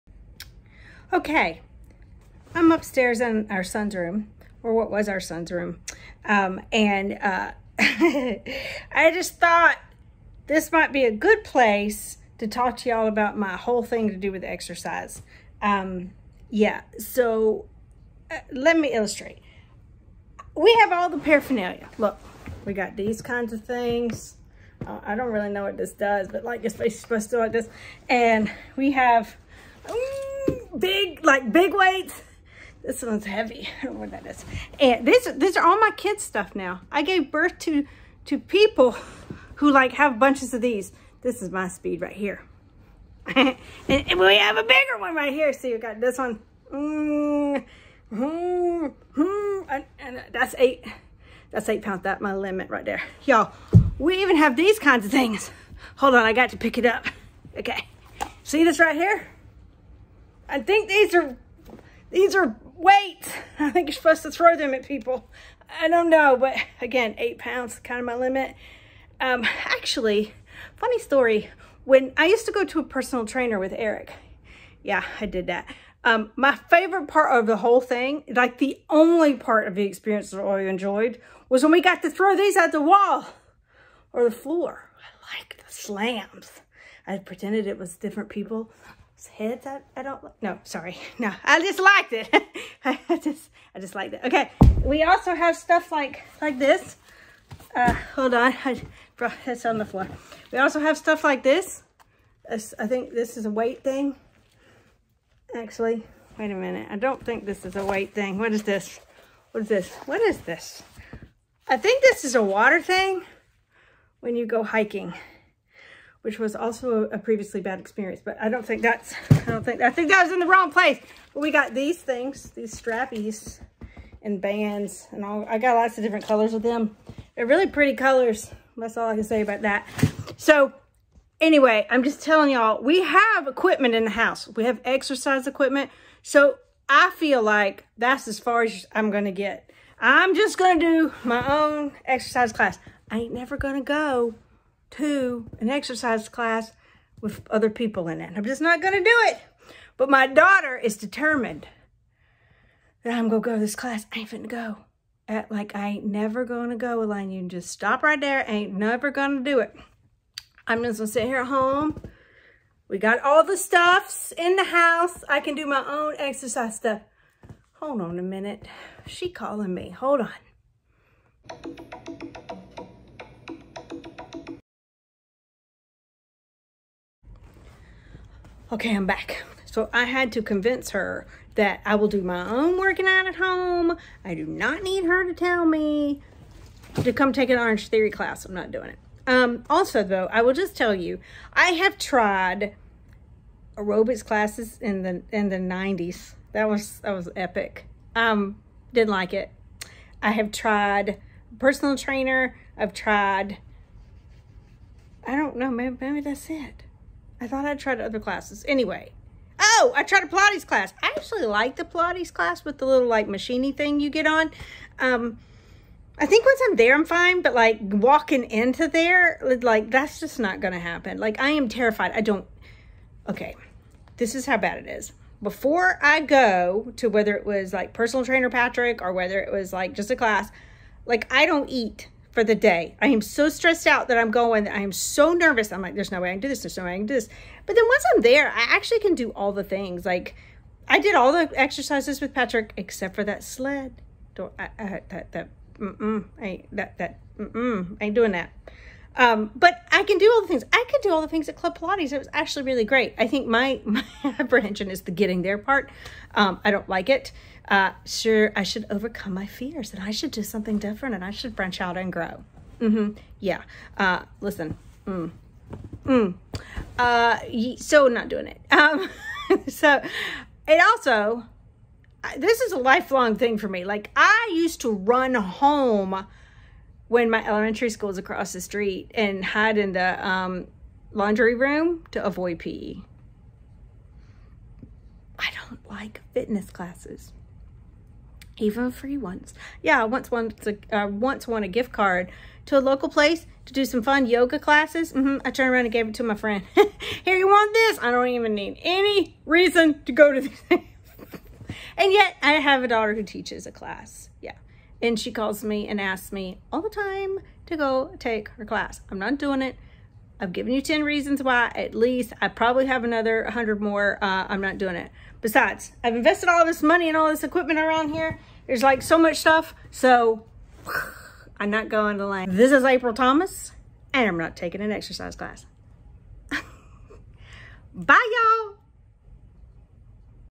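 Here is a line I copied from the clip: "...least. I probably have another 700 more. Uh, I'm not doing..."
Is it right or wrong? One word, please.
wrong.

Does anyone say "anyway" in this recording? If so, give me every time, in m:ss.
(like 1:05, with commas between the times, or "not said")
2:11, 3:28.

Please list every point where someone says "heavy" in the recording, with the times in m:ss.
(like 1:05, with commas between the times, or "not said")
0:33.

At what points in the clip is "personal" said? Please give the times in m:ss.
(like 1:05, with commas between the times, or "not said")
1:12, 3:21, 3:47.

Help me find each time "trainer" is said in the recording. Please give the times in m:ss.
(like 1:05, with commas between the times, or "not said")
1:13, 3:21, 3:48.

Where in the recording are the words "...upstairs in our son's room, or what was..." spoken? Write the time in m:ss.
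0:02.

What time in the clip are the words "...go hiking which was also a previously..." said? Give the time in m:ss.
1:54.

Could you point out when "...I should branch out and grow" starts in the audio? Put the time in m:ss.
4:21.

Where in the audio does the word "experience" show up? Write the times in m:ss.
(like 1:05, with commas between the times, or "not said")
1:19, 1:57.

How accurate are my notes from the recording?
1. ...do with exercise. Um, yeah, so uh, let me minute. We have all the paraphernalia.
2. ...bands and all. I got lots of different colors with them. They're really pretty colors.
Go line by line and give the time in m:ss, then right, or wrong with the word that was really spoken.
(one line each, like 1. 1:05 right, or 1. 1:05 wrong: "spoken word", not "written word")
1. 0:14 wrong: "illustrate", not "minute"
2. 2:04 right.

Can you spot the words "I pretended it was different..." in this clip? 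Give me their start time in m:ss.
1:27.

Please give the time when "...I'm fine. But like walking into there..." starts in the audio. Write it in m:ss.
3:36.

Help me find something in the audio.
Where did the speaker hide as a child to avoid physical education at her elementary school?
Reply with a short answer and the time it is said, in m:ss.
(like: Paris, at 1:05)
laundry room, at 4:41.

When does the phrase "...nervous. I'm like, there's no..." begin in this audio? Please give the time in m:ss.
3:55.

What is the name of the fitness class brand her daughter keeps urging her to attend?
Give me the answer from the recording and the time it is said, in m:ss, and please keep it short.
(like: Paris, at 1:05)
Orangetheory, at 3:07.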